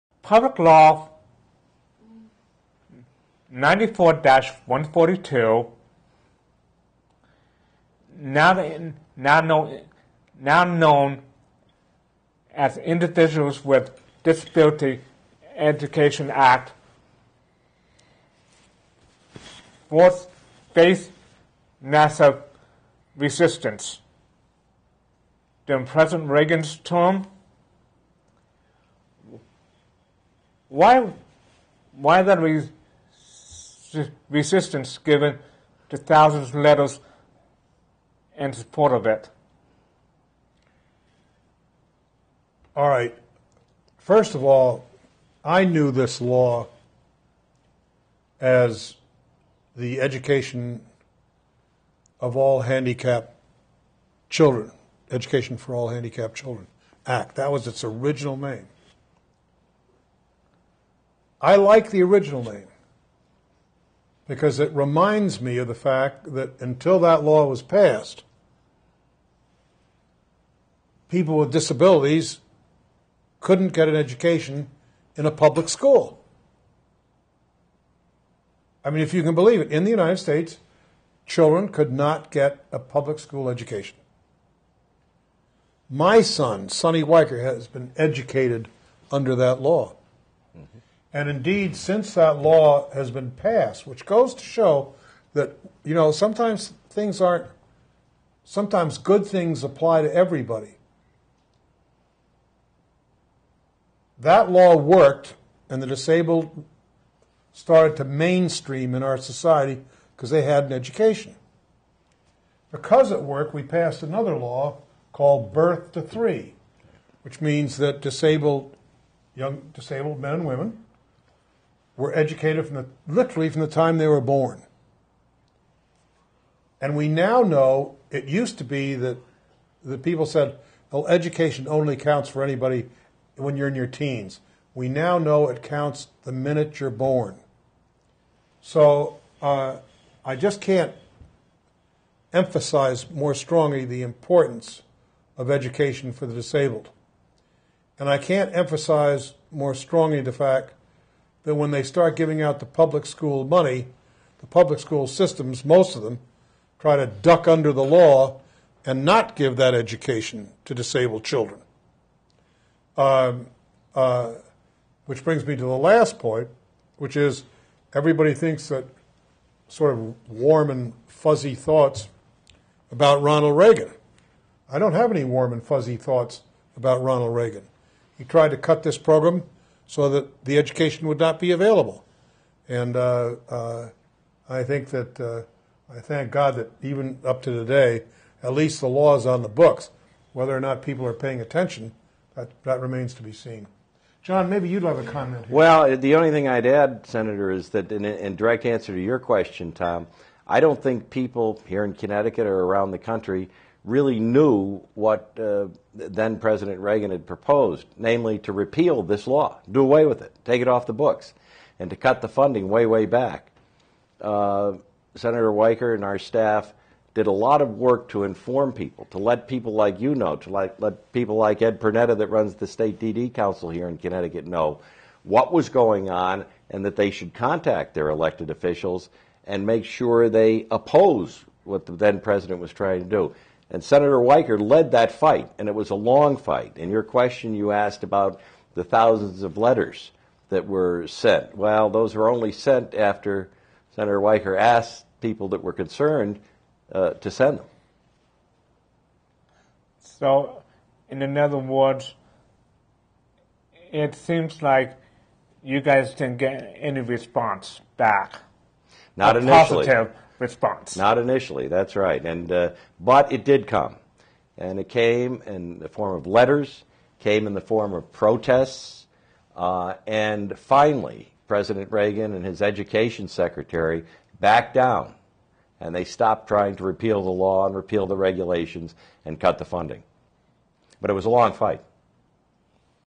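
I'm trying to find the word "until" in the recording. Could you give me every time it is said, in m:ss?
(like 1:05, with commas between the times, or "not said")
1:06.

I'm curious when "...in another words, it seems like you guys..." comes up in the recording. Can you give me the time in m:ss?
4:11.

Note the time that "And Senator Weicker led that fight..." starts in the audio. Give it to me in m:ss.
3:53.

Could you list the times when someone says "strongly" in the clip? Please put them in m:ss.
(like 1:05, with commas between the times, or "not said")
2:23, 2:29.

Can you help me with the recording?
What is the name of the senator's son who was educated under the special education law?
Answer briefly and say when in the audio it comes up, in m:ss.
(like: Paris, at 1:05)
Sonny Weicker, at 1:26.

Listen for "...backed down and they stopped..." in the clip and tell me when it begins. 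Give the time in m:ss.
4:34.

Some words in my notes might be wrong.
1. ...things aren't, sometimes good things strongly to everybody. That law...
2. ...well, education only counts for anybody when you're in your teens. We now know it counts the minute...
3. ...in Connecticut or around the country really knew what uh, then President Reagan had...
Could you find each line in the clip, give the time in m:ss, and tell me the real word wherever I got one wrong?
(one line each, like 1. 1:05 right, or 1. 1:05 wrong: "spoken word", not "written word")
1. 1:36 wrong: "apply", not "strongly"
2. 2:10 right
3. 3:21 right.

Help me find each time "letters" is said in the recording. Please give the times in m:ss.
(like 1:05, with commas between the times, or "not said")
0:36, 3:59, 4:26.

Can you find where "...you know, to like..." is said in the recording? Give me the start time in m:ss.
3:39.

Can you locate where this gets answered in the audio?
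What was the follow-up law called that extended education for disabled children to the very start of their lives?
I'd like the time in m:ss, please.
1:55.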